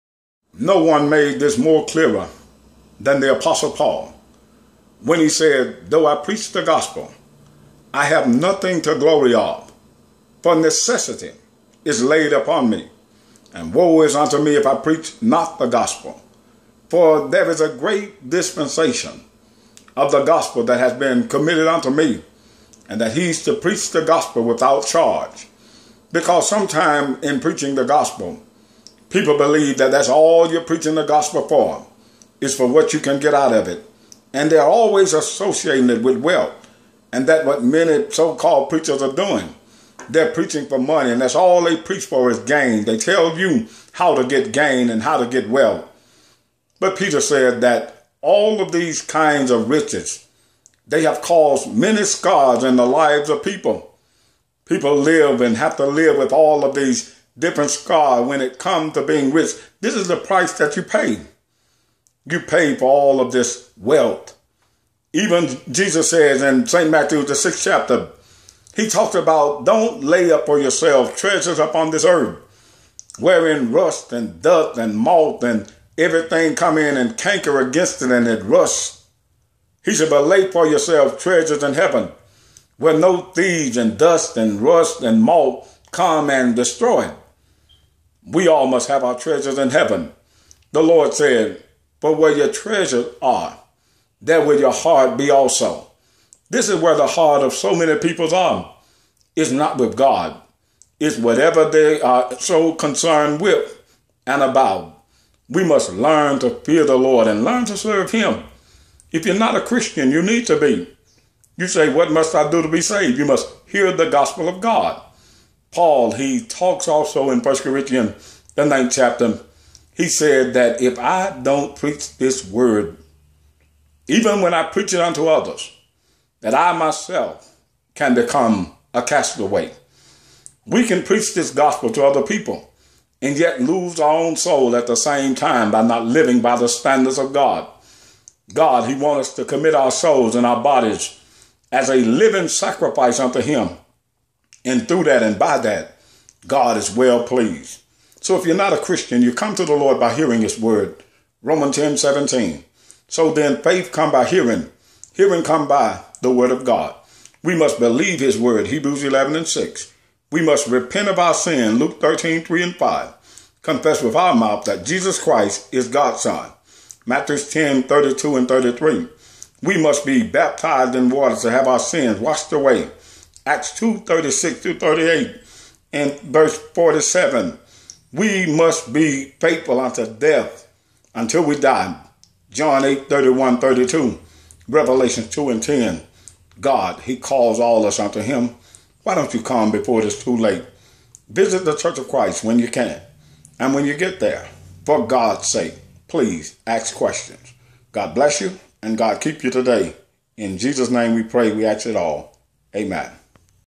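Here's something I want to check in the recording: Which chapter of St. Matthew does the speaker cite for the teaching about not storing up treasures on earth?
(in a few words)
6th chapter.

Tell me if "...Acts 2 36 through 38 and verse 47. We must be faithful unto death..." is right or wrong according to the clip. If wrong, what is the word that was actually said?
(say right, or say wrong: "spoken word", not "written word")
right.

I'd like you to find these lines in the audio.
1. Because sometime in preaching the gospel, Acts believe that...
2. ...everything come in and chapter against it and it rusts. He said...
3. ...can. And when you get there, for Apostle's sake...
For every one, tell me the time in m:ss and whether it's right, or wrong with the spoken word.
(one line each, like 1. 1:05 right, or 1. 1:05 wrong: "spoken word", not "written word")
1. 0:26 wrong: "People", not "Acts"
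2. 1:15 wrong: "canker", not "chapter"
3. 3:12 wrong: "God", not "Apostle".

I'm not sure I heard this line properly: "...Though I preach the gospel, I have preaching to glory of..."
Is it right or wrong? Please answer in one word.
wrong.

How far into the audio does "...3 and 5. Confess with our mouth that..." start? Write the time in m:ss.
2:42.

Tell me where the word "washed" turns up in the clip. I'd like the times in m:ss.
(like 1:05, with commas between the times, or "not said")
2:52.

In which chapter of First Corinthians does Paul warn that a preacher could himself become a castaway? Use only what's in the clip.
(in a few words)
9th chapter.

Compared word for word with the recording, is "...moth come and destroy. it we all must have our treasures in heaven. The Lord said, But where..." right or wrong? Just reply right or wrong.
right.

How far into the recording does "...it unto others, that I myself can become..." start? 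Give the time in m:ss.
2:04.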